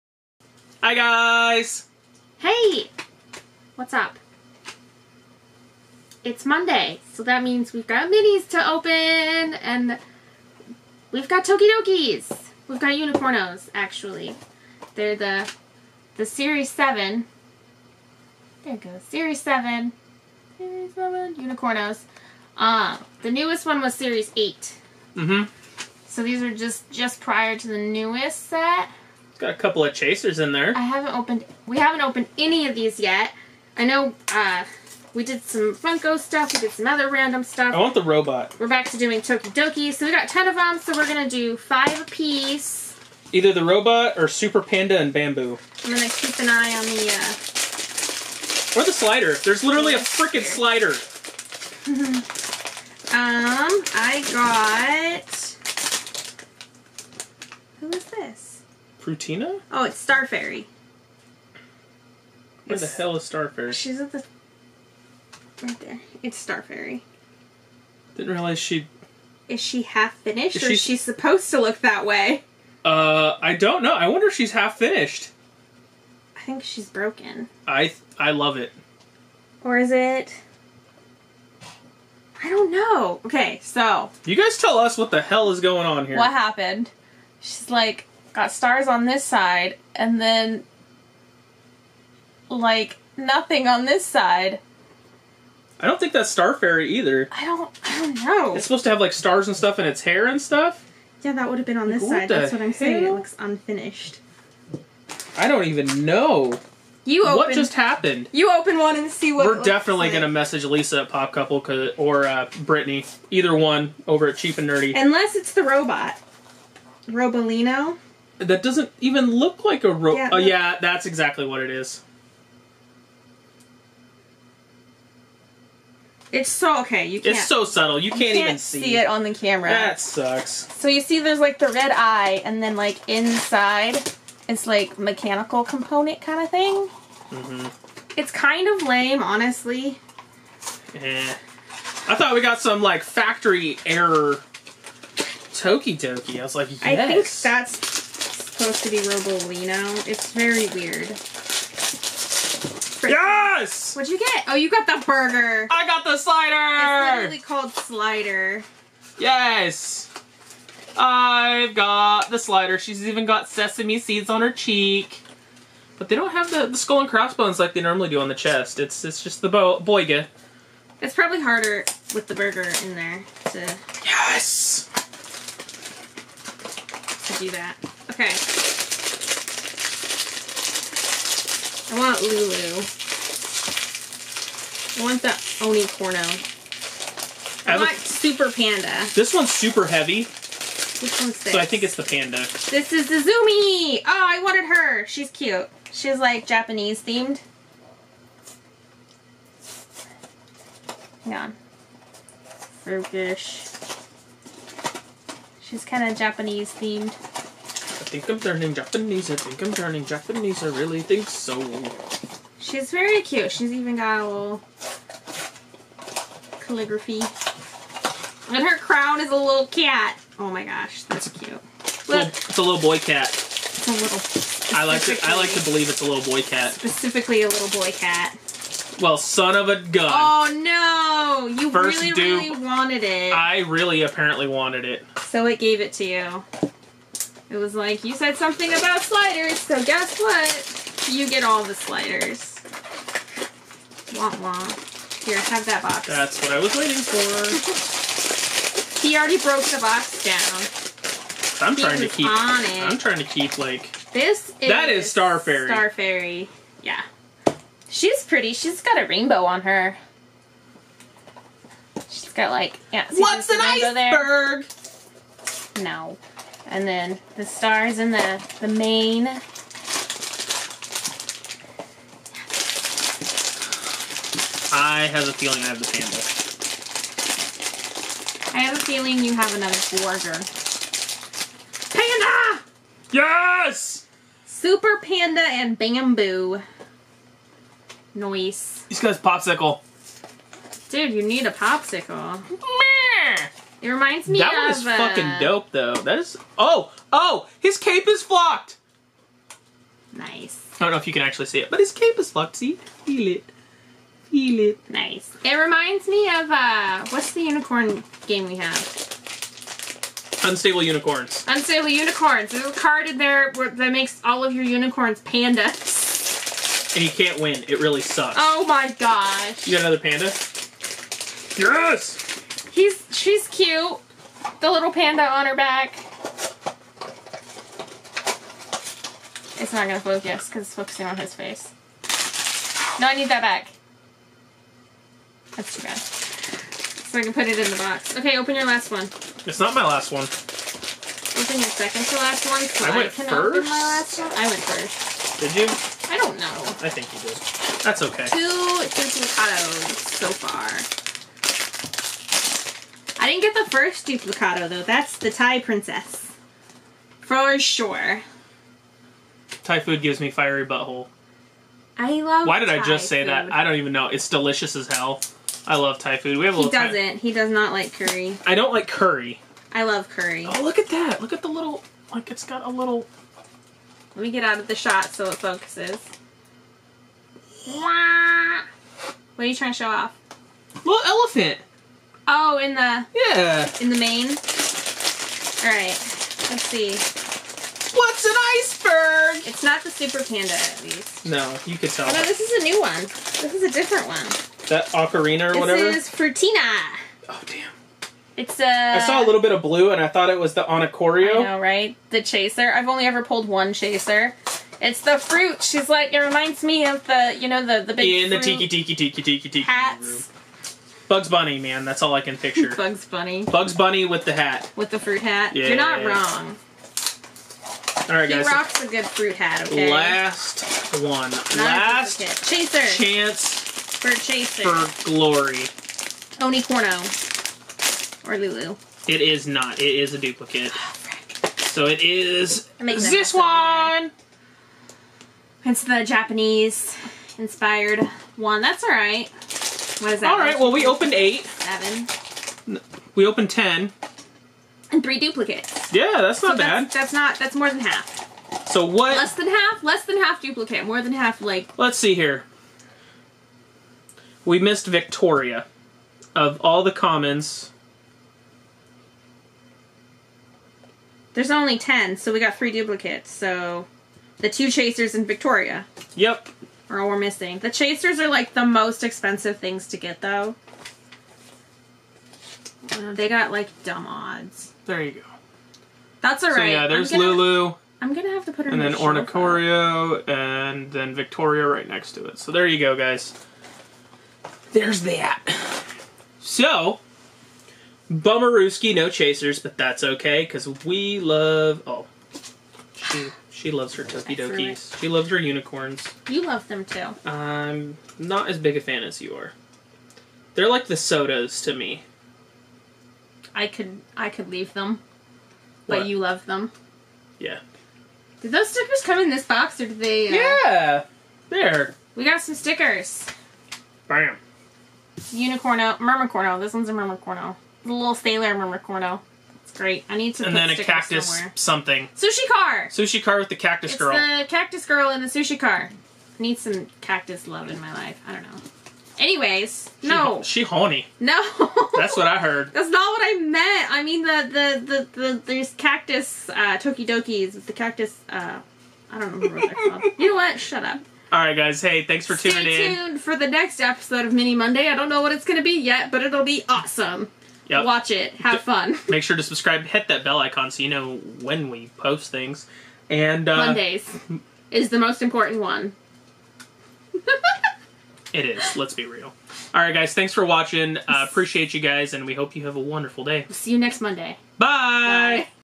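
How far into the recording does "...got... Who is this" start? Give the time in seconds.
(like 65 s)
55 s.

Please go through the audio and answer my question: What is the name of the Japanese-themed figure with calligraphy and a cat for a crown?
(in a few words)
Zumi.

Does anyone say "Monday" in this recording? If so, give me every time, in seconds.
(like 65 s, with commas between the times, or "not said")
6 s, 544 s, 553 s, 564 s.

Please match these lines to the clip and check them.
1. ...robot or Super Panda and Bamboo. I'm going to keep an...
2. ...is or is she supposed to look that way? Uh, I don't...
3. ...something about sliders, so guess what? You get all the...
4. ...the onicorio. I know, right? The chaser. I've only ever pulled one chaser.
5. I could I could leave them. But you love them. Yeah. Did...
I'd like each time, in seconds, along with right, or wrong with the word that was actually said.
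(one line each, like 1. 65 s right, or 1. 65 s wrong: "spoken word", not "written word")
1. 43 s right
2. 70 s right
3. 238 s right
4. 400 s right
5. 503 s right.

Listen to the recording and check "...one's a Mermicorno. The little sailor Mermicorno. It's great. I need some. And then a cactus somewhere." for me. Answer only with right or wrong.
right.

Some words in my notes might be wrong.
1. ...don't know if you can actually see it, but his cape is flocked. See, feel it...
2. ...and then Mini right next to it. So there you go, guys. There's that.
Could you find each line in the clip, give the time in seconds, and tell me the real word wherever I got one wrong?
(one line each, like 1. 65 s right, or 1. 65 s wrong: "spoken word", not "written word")
1. 300 s right
2. 480 s wrong: "Victoria", not "Mini".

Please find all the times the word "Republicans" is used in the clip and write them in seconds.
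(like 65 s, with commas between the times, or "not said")
not said.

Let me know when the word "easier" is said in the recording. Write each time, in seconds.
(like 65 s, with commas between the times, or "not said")
not said.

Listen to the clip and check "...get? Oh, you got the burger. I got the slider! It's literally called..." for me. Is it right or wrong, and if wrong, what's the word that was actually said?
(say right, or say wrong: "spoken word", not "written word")
right.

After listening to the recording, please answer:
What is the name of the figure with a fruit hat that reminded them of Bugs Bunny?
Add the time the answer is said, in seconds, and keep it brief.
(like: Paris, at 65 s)
Frutina, at 395 s.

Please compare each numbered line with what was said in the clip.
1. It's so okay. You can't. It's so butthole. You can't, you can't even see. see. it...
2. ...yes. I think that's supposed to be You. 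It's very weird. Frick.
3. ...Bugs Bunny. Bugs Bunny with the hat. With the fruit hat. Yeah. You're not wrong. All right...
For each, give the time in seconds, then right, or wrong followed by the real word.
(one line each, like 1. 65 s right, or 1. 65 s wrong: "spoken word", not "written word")
1. 126 s wrong: "subtle", not "butthole"
2. 146 s wrong: "Robolino", not "You"
3. 412 s right.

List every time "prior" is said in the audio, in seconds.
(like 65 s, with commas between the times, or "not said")
27 s.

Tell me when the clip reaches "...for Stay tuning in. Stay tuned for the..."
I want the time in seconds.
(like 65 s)
542 s.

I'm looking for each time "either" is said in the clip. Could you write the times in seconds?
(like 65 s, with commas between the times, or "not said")
43 s, 96 s, 113 s.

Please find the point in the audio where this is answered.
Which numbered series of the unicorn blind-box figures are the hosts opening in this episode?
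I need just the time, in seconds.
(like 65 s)
20 s.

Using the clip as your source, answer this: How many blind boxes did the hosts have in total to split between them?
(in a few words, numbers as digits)
10.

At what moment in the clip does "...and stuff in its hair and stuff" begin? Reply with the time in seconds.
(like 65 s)
99 s.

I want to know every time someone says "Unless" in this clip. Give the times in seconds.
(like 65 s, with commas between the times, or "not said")
114 s.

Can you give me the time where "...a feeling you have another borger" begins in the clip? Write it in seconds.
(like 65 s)
278 s.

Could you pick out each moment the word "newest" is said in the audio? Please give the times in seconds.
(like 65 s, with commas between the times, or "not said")
23 s, 27 s.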